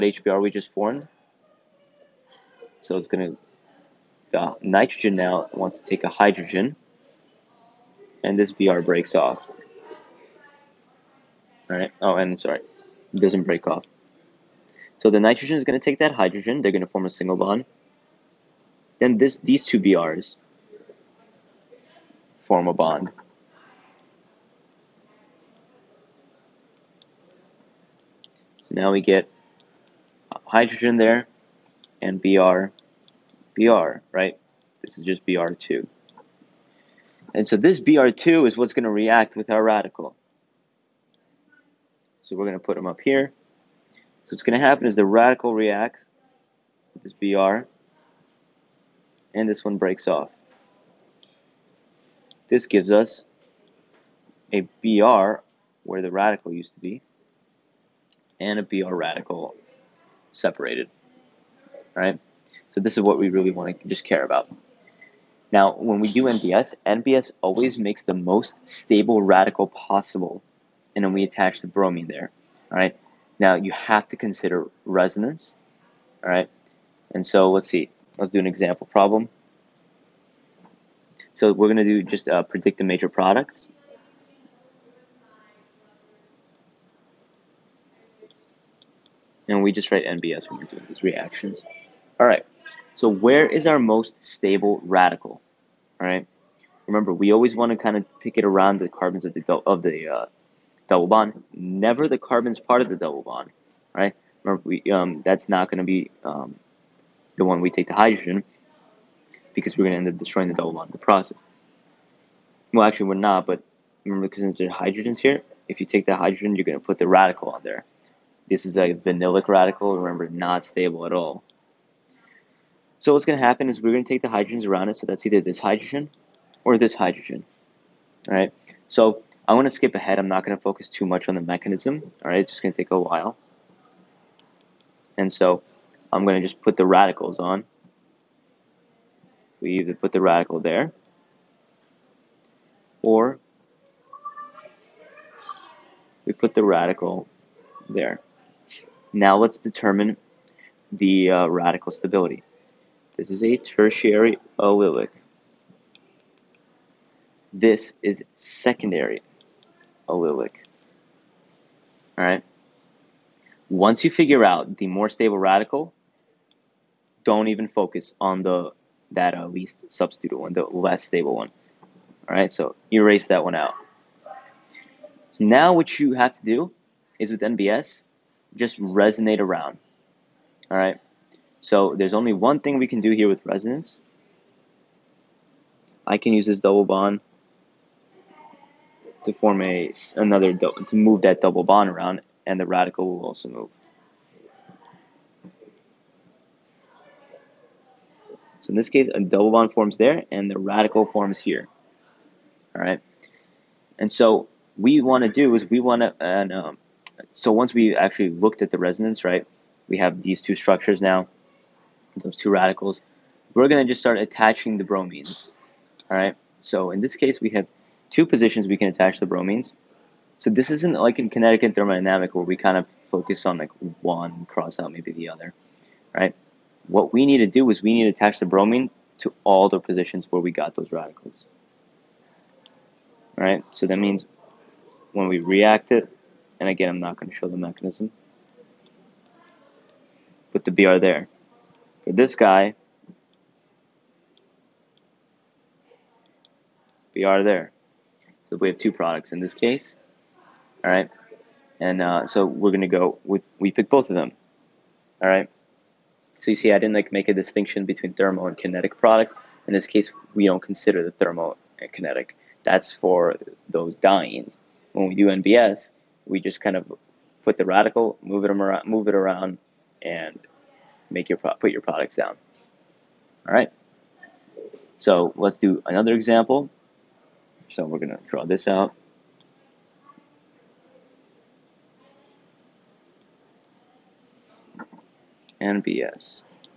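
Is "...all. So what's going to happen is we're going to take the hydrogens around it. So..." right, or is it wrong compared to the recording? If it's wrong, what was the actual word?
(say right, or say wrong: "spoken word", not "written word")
right.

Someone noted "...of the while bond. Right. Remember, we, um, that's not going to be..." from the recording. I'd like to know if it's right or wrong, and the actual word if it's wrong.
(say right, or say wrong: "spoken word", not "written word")
wrong: "double", not "while".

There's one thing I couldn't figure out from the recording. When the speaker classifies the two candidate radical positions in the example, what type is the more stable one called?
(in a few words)
Tertiary allylic.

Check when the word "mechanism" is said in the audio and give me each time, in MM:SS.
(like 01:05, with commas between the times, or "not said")
02:11, 03:57.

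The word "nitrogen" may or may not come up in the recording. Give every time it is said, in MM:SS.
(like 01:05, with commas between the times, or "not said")
00:04, 00:15.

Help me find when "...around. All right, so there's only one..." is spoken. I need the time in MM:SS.
02:59.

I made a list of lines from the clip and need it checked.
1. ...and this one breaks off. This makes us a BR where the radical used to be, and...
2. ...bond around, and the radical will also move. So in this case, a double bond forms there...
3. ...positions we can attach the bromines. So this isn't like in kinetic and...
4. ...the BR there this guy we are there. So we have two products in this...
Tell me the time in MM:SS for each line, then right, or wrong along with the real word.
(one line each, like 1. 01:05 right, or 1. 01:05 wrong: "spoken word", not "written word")
1. 00:49 wrong: "gives", not "makes"
2. 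03:11 right
3. 03:38 right
4. 04:00 right.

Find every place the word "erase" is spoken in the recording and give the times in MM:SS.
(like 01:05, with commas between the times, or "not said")
02:52.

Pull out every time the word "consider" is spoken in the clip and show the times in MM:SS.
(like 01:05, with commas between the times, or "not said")
01:14, 04:20.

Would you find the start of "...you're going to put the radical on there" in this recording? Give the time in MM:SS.
01:56.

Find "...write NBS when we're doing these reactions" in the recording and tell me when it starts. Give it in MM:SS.
01:29.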